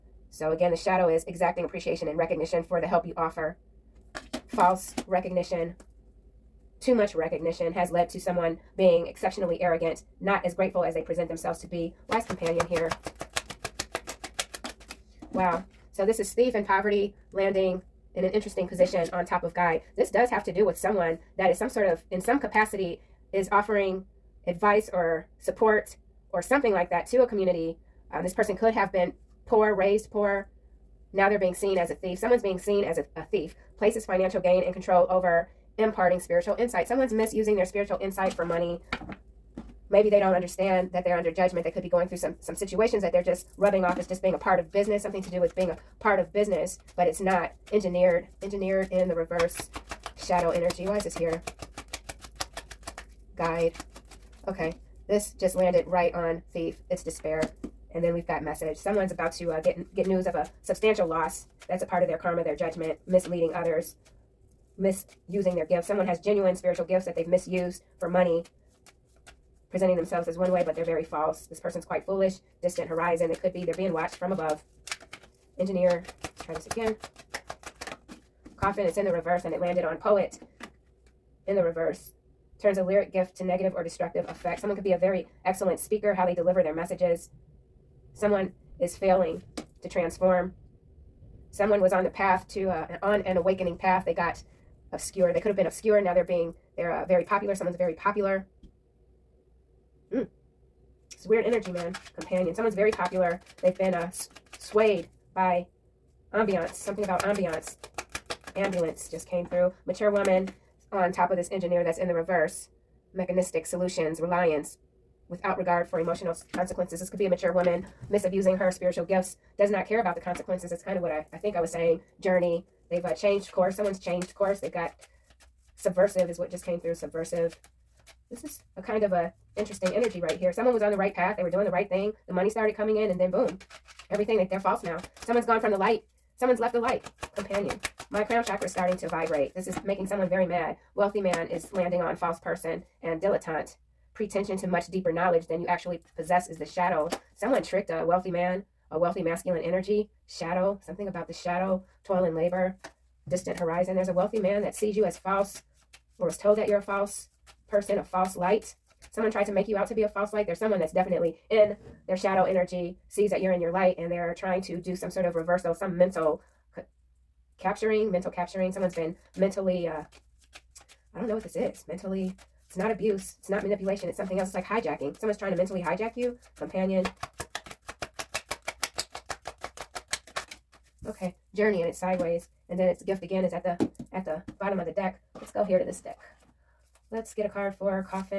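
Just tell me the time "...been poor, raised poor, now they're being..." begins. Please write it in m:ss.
0:28.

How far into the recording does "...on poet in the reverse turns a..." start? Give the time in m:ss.
1:19.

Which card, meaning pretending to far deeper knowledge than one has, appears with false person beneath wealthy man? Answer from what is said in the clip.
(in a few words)
Dilettante.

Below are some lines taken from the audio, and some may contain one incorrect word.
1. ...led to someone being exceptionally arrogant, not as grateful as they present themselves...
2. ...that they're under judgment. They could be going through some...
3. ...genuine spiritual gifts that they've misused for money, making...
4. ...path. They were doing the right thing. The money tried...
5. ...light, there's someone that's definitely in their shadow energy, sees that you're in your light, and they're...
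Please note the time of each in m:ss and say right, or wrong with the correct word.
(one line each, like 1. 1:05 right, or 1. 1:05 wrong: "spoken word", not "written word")
1. 0:07 right
2. 0:40 right
3. 1:06 wrong: "presenting", not "making"
4. 2:11 wrong: "started", not "tried"
5. 2:40 right.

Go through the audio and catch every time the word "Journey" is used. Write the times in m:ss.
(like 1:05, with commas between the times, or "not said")
2:02, 3:01.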